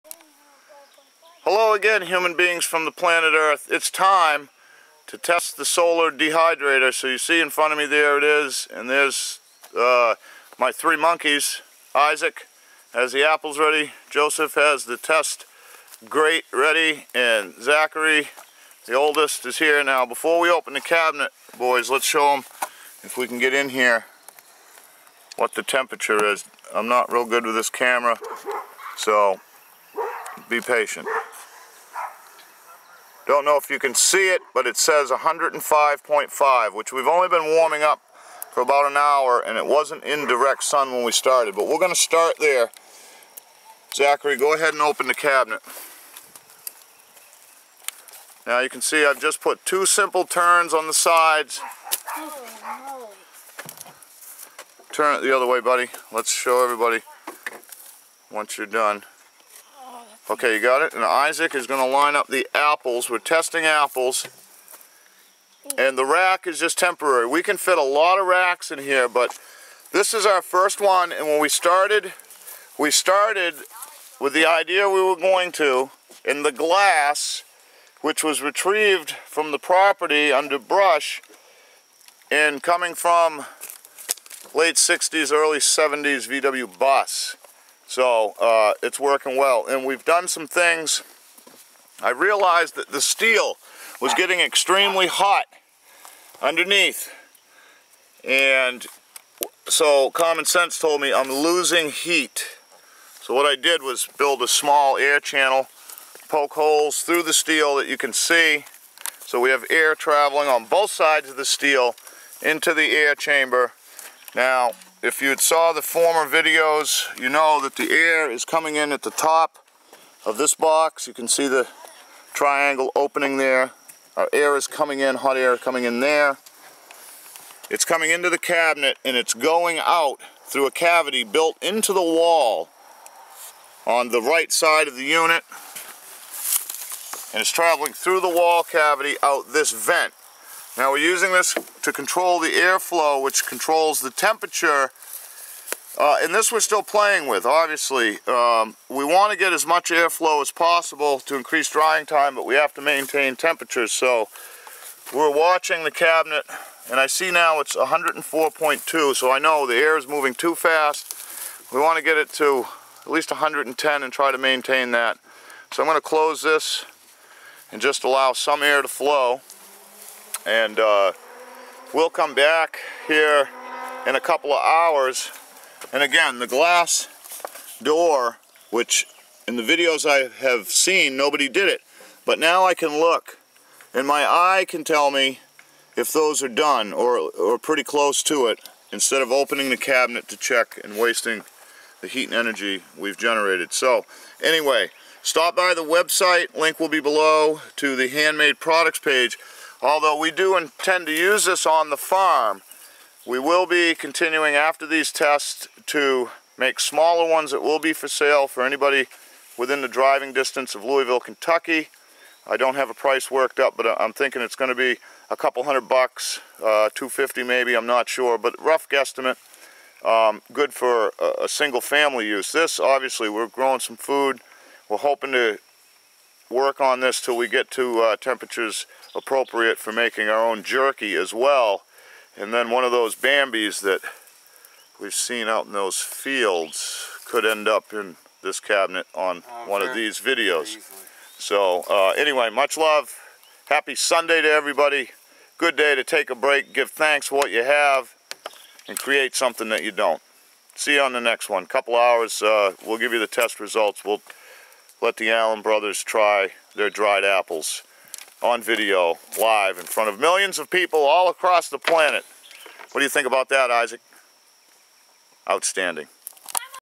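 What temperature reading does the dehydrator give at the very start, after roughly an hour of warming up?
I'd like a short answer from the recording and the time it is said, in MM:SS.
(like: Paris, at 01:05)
105.5, at 00:35.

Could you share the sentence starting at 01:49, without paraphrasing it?
So we have air traveling on both sides of the steel into the air chamber.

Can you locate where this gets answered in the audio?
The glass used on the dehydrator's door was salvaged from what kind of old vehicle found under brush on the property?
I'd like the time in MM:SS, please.
01:26.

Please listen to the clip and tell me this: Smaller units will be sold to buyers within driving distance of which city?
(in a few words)
Louisville, Kentucky.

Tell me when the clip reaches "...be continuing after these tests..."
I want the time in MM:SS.
03:23.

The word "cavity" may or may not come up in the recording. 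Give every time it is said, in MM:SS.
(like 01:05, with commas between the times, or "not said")
02:10, 02:18.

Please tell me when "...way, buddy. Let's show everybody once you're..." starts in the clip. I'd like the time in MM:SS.
00:55.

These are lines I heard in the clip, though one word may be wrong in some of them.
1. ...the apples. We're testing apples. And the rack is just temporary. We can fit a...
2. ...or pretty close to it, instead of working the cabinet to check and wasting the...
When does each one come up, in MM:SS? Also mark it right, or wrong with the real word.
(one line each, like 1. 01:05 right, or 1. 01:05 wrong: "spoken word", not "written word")
1. 01:02 right
2. 03:07 wrong: "opening", not "working".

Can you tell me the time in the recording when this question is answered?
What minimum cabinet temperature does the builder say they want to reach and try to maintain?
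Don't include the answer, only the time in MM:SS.
02:43.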